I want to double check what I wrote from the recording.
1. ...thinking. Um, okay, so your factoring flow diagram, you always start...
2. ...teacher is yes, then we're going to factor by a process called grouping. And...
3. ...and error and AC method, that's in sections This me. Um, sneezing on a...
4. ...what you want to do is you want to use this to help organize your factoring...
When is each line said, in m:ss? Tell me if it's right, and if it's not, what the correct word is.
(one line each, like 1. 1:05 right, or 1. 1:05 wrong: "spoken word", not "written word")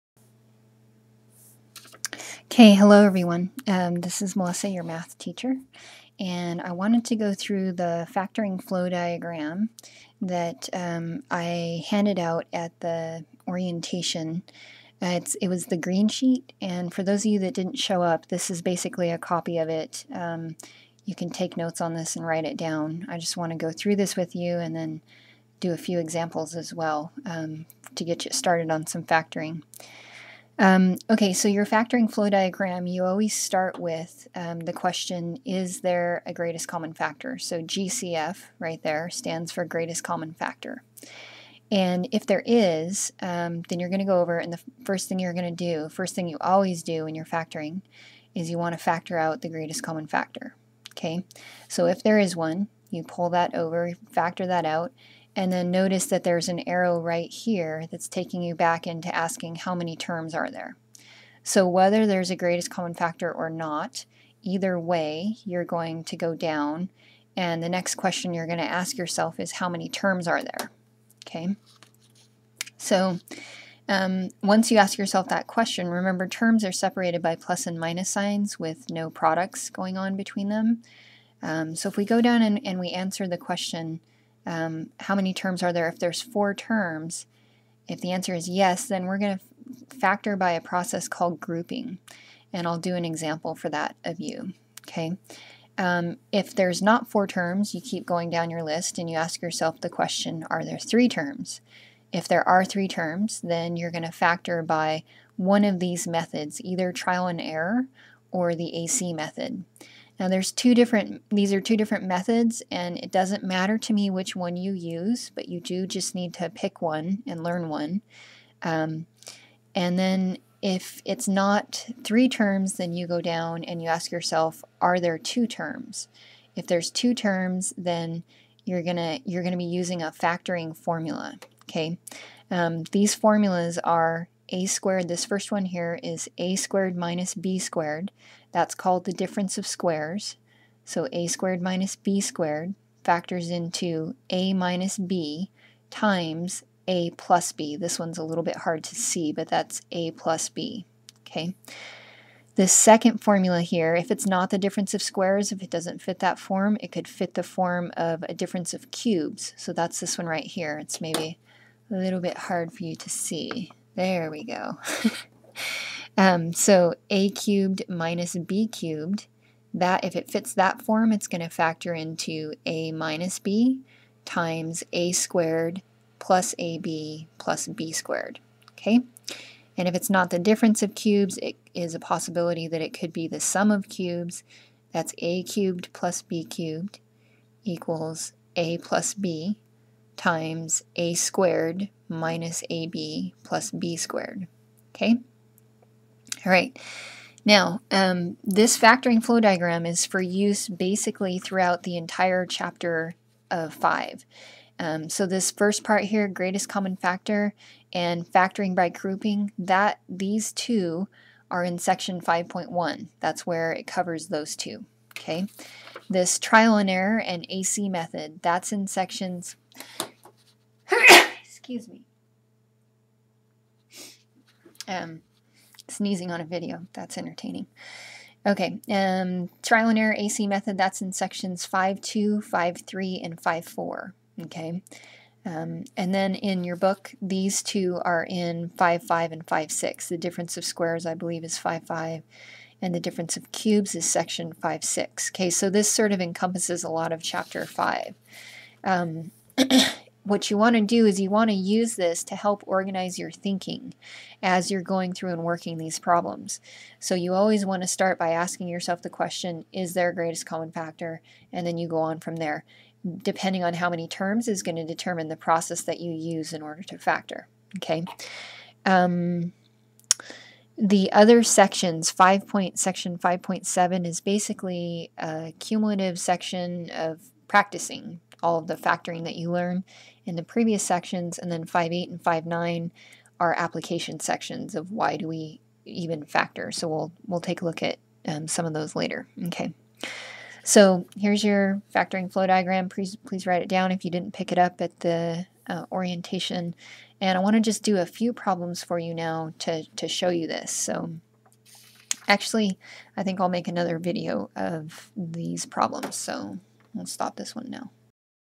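1. 0:29 wrong: "factoring", not "thinking"
2. 1:28 wrong: "answer", not "teacher"
3. 3:36 wrong: "Excuse", not "This"
4. 4:10 wrong: "thinking", not "factoring".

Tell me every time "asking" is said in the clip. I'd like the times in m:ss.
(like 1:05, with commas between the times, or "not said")
0:59, 4:18.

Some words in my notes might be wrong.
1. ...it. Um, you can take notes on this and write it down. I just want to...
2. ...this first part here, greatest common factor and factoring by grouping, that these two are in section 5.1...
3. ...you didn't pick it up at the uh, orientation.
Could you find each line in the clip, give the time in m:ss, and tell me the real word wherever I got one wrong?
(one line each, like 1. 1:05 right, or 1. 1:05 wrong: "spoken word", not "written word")
1. 0:19 right
2. 3:25 right
3. 4:54 right.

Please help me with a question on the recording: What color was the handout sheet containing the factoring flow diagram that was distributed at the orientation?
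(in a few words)
green.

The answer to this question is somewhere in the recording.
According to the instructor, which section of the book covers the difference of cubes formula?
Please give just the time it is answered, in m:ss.
4:04.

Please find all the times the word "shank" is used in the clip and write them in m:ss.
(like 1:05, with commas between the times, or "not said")
not said.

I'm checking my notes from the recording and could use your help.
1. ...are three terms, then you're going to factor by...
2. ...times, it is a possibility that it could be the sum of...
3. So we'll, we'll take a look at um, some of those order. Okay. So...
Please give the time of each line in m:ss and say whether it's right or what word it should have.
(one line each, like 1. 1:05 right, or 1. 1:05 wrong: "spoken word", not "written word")
1. 1:42 right
2. 3:00 wrong: "cubes", not "times"
3. 4:46 wrong: "later", not "order".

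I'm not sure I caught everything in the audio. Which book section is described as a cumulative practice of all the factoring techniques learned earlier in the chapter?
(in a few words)
5.7.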